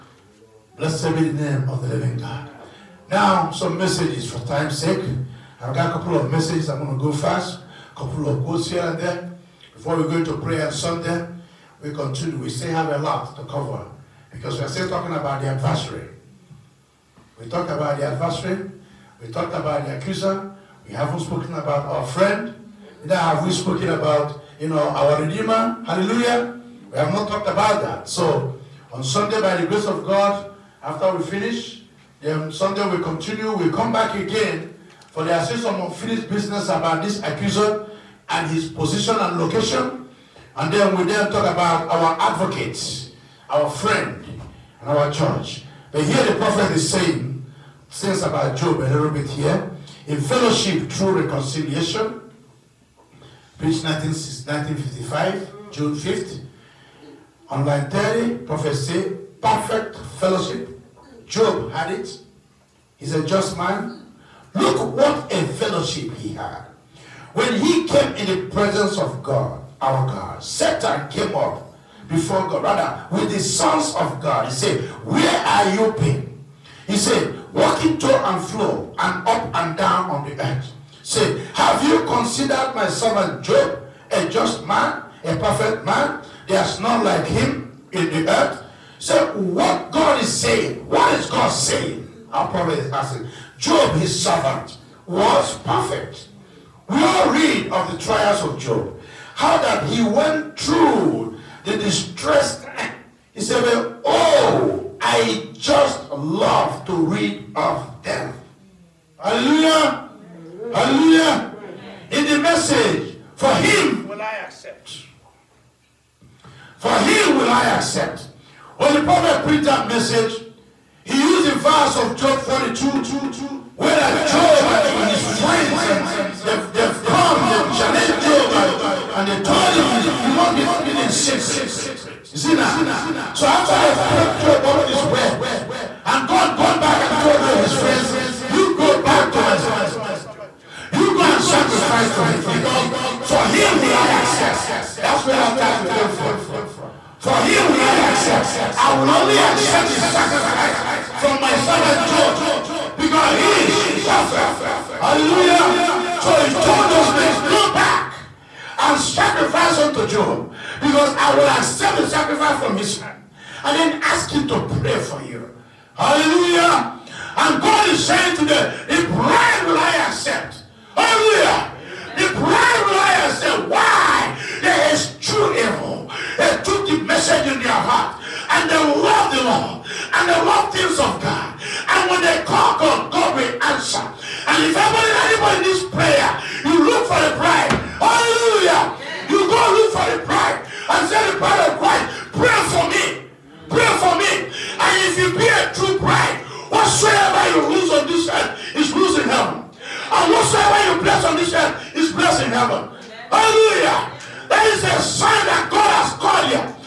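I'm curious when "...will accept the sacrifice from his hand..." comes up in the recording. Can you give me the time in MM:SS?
02:41.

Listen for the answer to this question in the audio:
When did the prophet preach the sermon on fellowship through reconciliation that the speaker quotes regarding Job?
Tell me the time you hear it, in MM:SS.
00:53.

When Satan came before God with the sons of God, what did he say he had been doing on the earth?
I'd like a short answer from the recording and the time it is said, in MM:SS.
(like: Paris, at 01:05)
Walking to and fro, at 01:17.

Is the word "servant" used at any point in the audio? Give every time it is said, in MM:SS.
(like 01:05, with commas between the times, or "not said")
01:22, 01:34, 02:19, 02:31.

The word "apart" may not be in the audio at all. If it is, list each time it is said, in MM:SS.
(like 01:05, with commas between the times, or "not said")
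not said.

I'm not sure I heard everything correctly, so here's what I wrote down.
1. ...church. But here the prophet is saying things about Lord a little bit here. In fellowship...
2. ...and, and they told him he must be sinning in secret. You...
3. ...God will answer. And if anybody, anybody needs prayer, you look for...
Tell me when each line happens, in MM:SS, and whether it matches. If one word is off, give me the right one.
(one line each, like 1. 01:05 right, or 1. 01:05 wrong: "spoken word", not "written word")
1. 00:45 wrong: "Job", not "Lord"
2. 02:08 right
3. 03:03 right.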